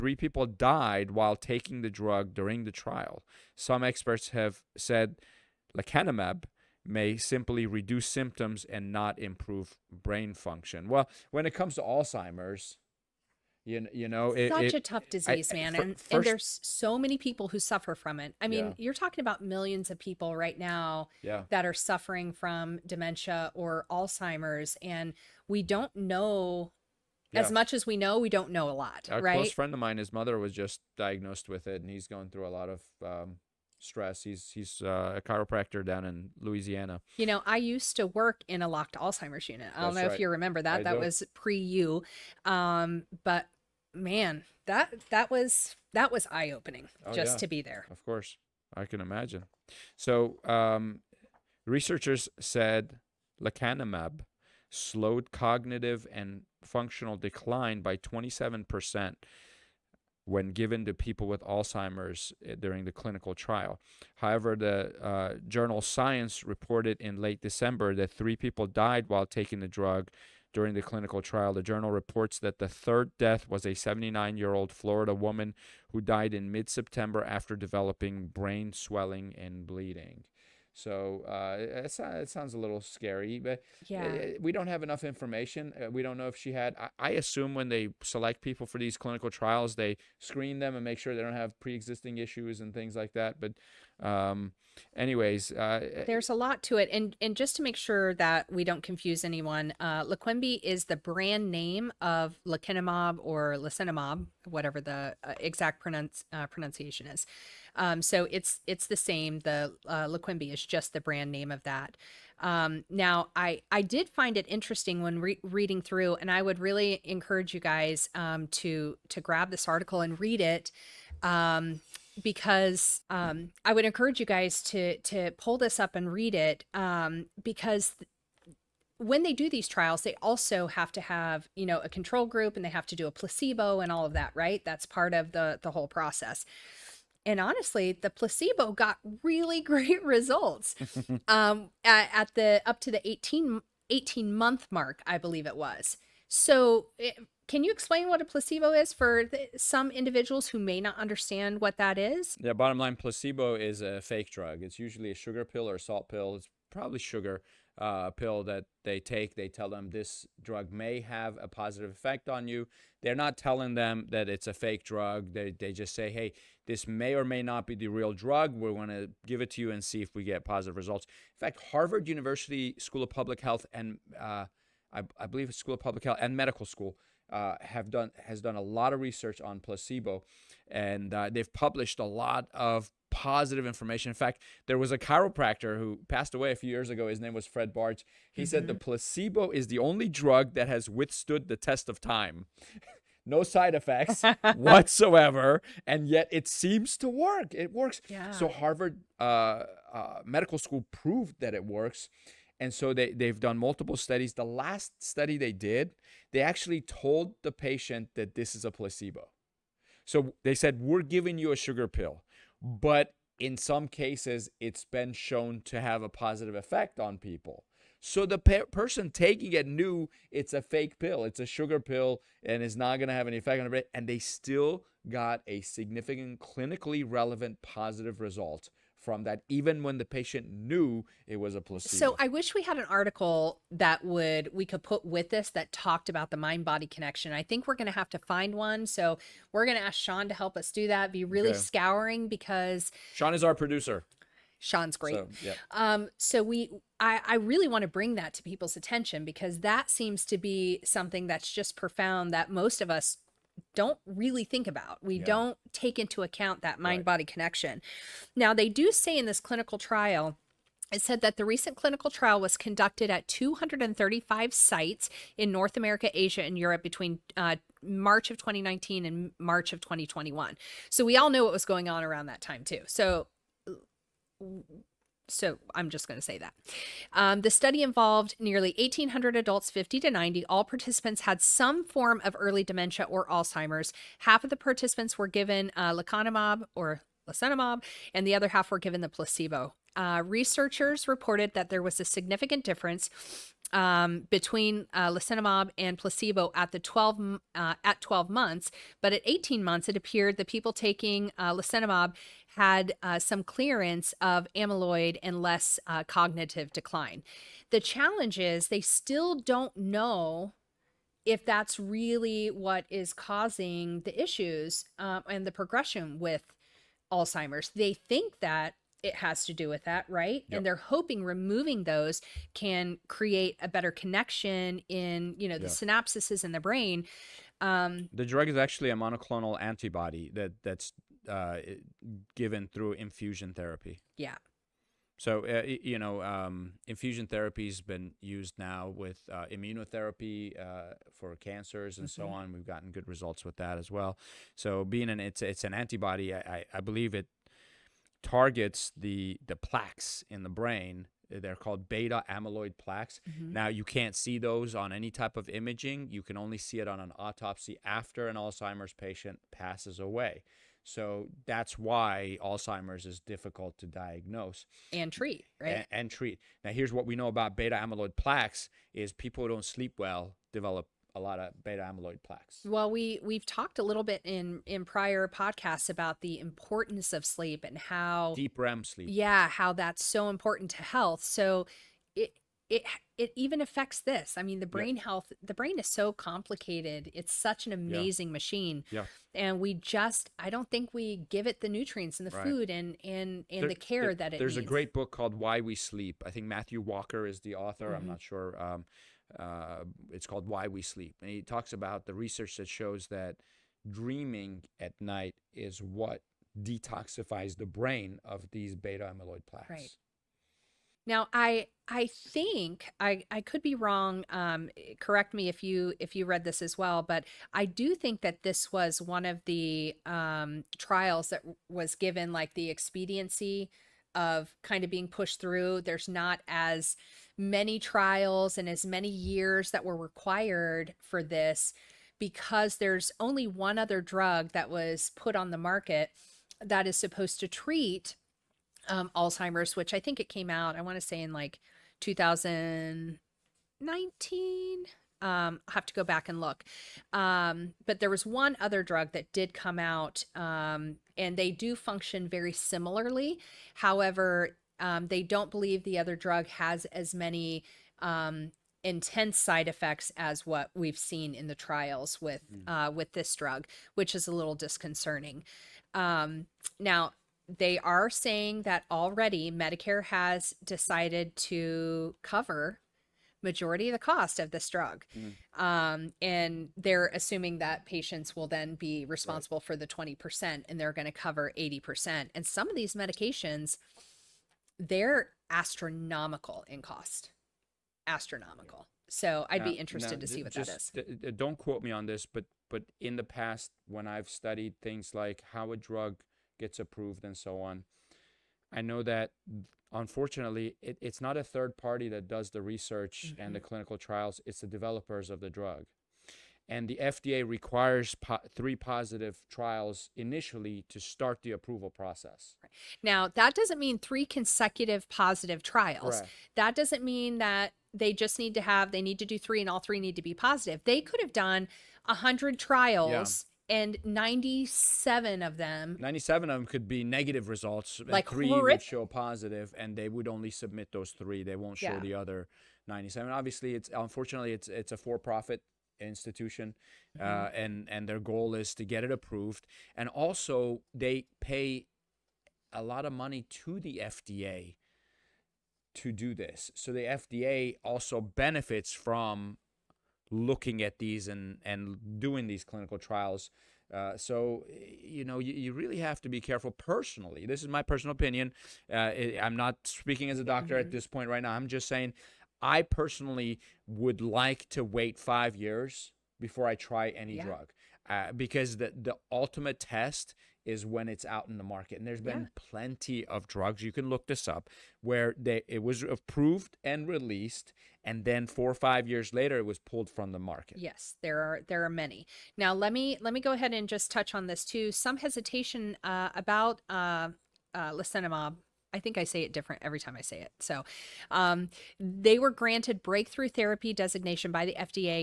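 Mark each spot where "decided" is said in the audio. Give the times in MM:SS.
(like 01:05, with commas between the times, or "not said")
07:50.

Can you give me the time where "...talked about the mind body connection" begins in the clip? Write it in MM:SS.
03:55.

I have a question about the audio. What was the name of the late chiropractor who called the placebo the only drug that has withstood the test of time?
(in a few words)
Fred Bartz.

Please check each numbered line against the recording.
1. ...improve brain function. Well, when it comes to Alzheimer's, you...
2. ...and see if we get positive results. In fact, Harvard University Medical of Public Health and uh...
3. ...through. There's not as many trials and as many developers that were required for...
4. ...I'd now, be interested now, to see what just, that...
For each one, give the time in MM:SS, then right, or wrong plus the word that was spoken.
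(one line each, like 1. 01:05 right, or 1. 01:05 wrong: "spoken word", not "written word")
1. 00:09 right
2. 02:49 wrong: "School", not "Medical"
3. 07:05 wrong: "years", not "developers"
4. 08:09 right.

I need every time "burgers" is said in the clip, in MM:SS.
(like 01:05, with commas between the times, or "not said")
not said.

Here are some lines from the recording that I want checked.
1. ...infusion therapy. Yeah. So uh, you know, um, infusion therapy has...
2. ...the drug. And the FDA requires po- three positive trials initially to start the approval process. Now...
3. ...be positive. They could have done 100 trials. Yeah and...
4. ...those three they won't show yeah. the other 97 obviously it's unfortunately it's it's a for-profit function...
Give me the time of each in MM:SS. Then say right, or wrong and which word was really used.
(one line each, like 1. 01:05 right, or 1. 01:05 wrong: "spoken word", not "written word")
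1. 05:32 right
2. 08:25 right
3. 08:40 right
4. 08:50 wrong: "institution", not "function".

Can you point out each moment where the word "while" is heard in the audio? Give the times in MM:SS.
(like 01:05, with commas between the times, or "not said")
00:01, 01:09.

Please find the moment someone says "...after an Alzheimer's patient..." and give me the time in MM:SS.
05:57.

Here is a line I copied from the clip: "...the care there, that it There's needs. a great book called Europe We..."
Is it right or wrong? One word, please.
wrong.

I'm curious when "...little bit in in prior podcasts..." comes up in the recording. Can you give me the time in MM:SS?
06:13.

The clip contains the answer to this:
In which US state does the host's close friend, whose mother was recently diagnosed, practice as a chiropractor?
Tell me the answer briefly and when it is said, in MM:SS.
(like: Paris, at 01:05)
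Louisiana, at 00:36.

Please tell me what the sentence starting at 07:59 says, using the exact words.
for the 20% and they're going to cover 80%.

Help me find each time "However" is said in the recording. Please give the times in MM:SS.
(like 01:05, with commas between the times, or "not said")
01:04, 07:33.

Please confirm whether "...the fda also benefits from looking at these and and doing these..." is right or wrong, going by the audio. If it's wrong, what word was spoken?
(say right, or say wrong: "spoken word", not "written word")
right.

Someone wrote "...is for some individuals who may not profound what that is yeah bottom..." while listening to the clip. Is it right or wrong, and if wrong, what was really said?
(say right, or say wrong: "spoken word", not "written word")
wrong: "understand", not "profound".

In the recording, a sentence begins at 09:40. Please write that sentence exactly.
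Yes, there are there are many.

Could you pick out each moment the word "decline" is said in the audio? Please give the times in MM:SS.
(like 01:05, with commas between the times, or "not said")
00:57, 05:06.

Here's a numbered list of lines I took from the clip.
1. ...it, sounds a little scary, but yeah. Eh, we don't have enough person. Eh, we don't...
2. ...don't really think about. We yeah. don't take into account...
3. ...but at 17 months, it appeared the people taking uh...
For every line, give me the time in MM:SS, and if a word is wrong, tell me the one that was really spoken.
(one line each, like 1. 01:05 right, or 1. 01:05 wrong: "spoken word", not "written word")
1. 01:21 wrong: "information", not "person"
2. 04:13 right
3. 04:59 wrong: "18", not "17".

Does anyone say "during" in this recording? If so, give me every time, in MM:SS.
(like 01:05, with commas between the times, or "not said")
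00:02, 01:02, 01:10.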